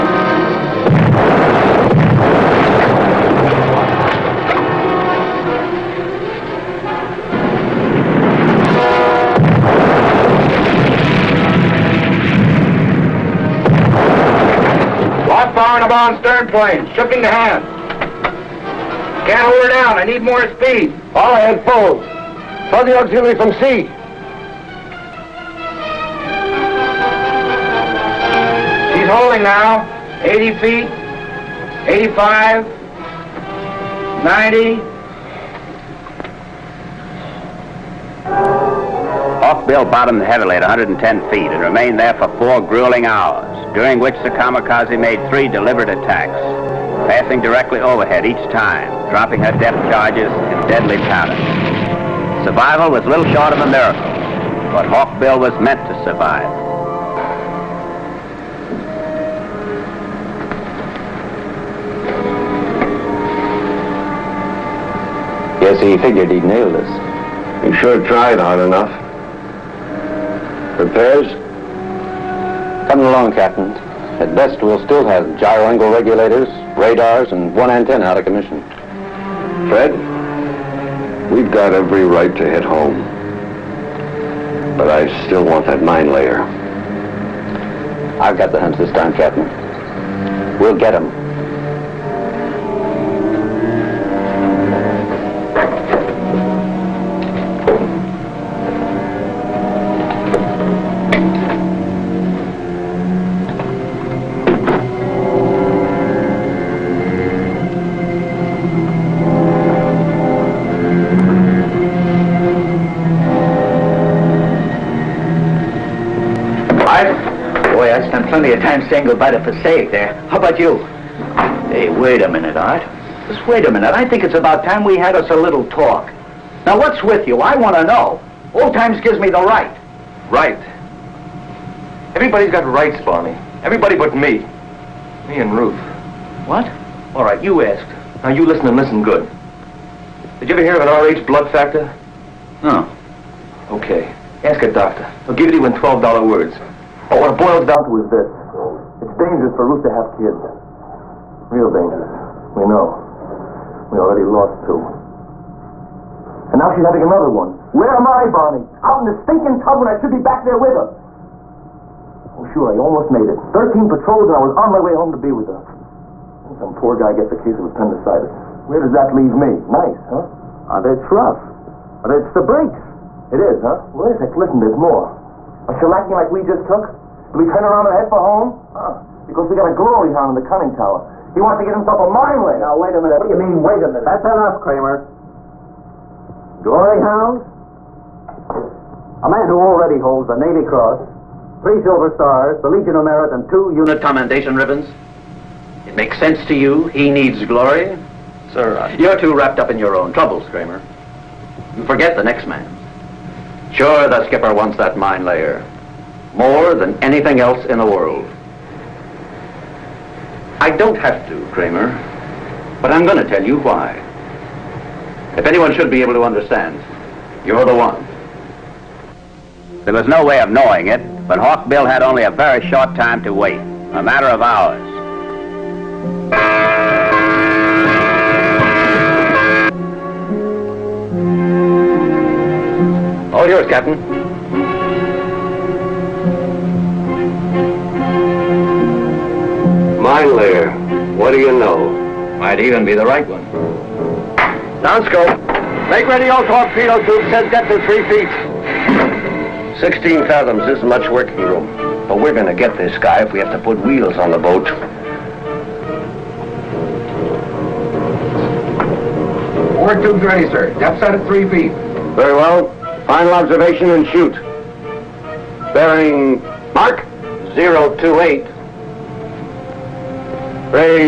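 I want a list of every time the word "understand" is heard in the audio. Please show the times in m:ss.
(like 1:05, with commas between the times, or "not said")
3:36.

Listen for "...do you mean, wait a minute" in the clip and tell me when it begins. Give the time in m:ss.
3:03.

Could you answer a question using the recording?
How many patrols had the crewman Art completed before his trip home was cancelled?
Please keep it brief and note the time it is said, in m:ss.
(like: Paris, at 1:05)
13, at 2:43.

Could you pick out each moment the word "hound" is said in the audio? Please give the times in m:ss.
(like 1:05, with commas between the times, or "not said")
3:00, 3:06.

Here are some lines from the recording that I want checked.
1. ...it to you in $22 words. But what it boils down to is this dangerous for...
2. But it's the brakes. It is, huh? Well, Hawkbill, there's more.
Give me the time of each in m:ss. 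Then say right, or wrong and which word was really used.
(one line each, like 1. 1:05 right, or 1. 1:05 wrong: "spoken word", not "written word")
1. 2:25 wrong: "12", not "22"
2. 2:52 wrong: "Listen", not "Hawkbill".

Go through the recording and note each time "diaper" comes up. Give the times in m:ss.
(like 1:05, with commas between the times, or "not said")
not said.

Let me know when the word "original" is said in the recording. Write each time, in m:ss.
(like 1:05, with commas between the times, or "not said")
not said.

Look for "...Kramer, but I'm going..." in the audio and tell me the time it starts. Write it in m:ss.
3:31.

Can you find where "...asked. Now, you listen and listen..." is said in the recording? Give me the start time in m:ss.
2:17.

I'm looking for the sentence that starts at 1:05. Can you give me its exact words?
Yes, he figured he'd nailed us.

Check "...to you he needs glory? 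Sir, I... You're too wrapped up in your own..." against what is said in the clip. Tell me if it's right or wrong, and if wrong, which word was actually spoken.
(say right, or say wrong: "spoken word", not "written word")
right.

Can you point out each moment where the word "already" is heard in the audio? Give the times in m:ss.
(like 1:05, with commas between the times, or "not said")
2:33, 3:09.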